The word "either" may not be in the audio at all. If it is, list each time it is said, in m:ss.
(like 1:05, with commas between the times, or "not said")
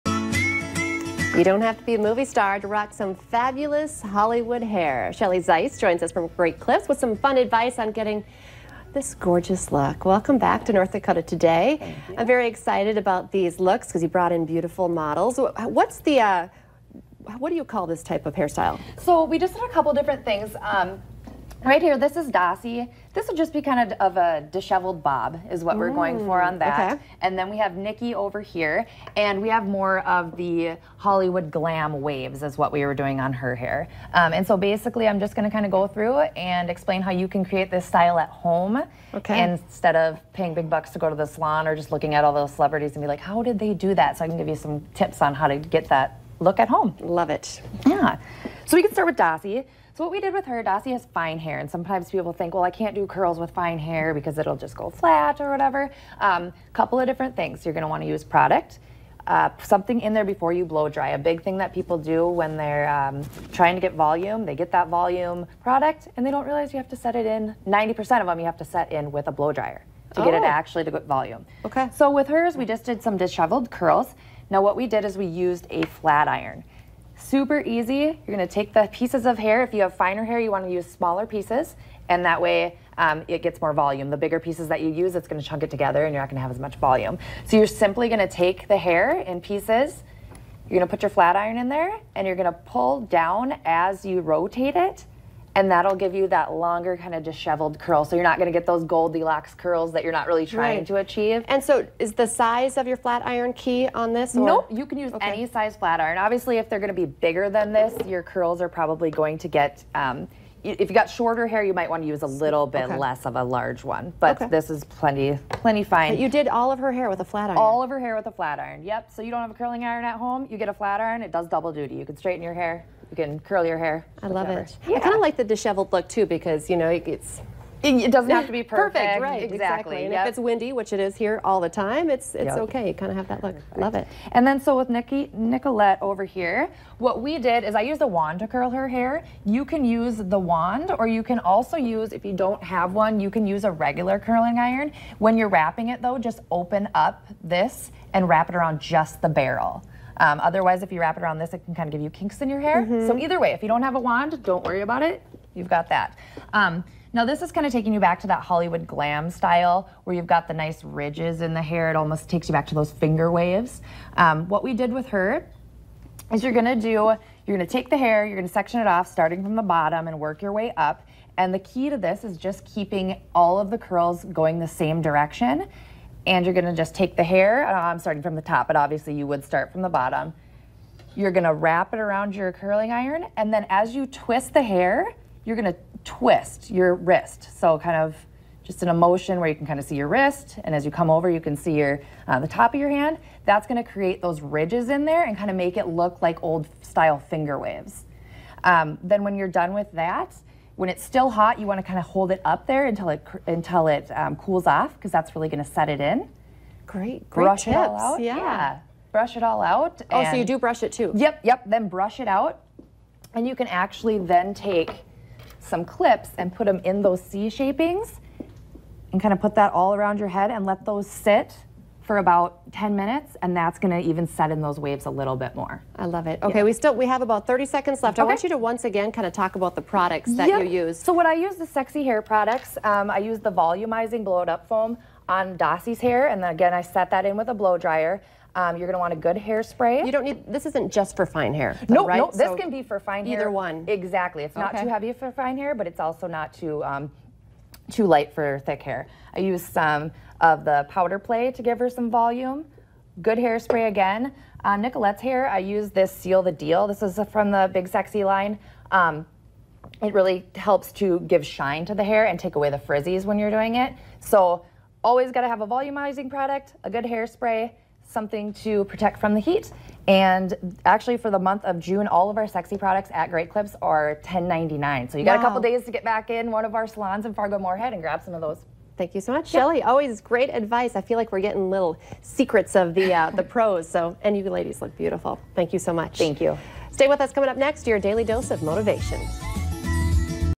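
2:33, 4:03.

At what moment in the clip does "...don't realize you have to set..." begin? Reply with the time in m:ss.
1:06.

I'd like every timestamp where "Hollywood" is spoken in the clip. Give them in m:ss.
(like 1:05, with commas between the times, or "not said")
0:04, 0:30, 2:38.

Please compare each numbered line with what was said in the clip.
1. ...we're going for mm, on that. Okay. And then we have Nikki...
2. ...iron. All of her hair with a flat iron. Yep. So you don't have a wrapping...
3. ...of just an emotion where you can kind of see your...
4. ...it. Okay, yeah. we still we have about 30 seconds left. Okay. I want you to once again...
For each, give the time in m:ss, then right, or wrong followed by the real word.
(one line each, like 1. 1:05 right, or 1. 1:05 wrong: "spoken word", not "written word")
1. 0:25 right
2. 1:57 wrong: "curling", not "wrapping"
3. 3:07 right
4. 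3:46 right.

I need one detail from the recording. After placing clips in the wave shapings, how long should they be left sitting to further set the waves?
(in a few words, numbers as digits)
10 minutes.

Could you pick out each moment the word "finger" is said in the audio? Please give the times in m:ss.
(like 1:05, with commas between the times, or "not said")
2:42, 3:17.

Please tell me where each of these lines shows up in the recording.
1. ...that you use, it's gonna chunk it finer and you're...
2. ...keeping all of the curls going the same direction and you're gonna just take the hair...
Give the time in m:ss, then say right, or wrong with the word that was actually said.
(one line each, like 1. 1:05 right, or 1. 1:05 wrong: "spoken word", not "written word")
1. 1:24 wrong: "together", not "finer"
2. 2:52 right.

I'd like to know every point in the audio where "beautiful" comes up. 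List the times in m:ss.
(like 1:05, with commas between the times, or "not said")
0:14, 4:44.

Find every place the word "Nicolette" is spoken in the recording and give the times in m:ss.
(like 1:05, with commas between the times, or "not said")
2:15, 4:14.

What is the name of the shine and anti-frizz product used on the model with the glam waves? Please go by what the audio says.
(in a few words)
Seal the Deal.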